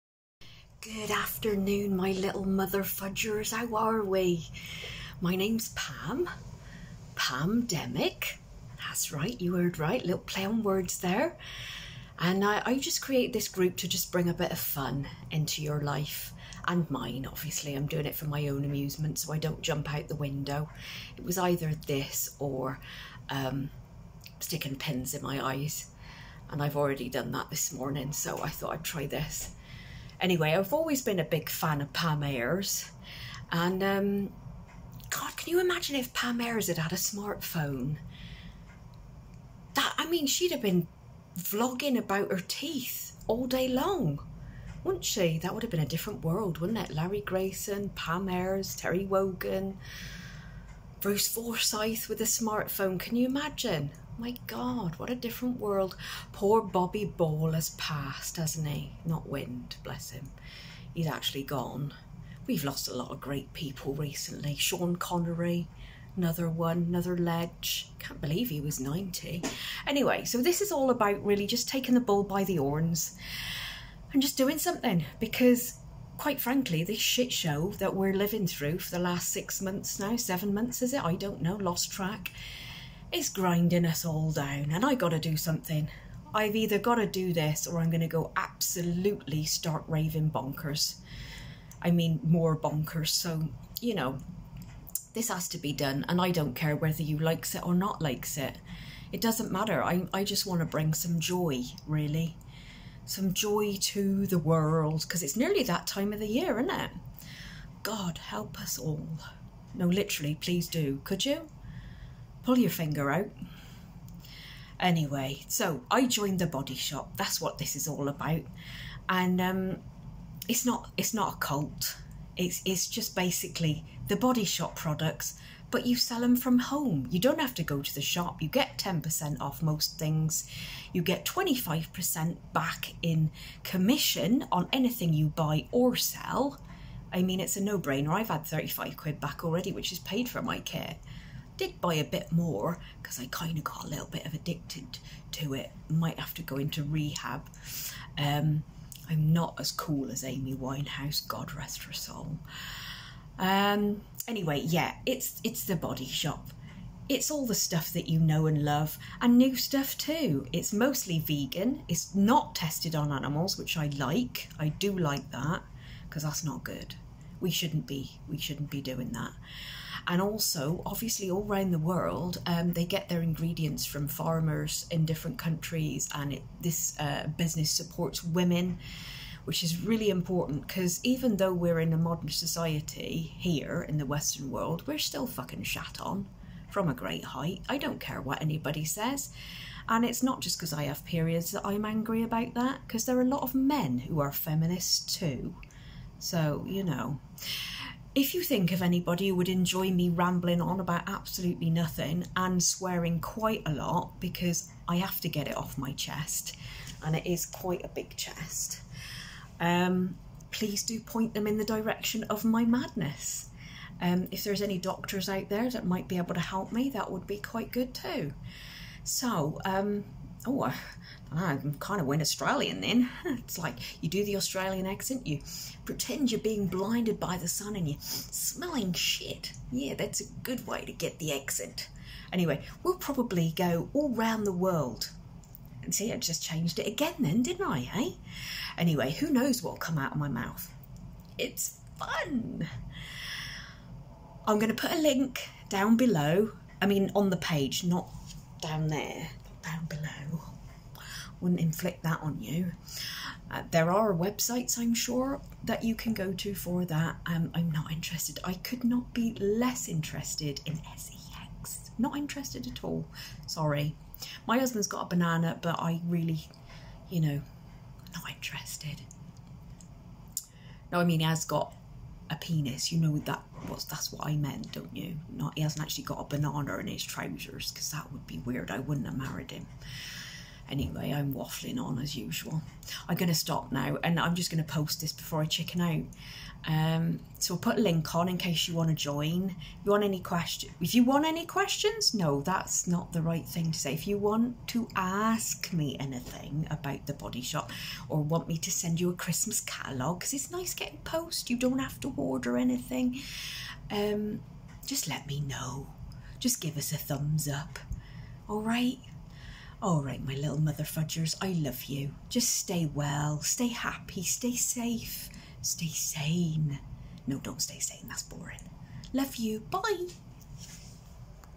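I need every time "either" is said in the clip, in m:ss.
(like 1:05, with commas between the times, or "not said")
0:21, 1:26.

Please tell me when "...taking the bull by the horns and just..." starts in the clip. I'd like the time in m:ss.
1:11.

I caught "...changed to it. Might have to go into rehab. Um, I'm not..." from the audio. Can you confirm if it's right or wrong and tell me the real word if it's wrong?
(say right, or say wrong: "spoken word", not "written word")
wrong: "addicted", not "changed".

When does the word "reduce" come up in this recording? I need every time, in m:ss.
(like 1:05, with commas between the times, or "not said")
not said.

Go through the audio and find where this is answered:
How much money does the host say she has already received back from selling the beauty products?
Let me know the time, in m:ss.
2:18.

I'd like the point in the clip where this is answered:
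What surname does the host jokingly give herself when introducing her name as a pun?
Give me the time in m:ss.
0:07.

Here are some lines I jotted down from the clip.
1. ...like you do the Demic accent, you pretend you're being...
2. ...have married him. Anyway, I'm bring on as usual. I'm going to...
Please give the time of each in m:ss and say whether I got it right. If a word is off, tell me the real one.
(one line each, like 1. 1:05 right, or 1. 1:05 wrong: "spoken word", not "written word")
1. 3:43 wrong: "Australian", not "Demic"
2. 4:39 wrong: "waffling", not "bring".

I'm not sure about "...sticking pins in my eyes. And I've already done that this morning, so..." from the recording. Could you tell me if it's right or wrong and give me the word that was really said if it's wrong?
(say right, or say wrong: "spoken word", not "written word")
right.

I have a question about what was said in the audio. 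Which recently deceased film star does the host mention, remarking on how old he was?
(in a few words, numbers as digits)
Sean Connery.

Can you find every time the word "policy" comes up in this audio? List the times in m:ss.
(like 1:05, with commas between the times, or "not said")
not said.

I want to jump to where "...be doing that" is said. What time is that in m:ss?
2:48.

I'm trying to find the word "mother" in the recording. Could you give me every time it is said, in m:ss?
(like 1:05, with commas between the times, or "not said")
0:02, 5:10.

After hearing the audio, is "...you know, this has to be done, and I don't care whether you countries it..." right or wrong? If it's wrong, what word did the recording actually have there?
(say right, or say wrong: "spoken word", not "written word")
wrong: "likes", not "countries".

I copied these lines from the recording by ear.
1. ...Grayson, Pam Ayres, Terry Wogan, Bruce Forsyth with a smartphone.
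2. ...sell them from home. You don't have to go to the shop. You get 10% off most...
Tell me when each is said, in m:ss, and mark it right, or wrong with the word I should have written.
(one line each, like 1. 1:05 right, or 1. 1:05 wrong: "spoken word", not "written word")
1. 0:47 right
2. 2:05 right.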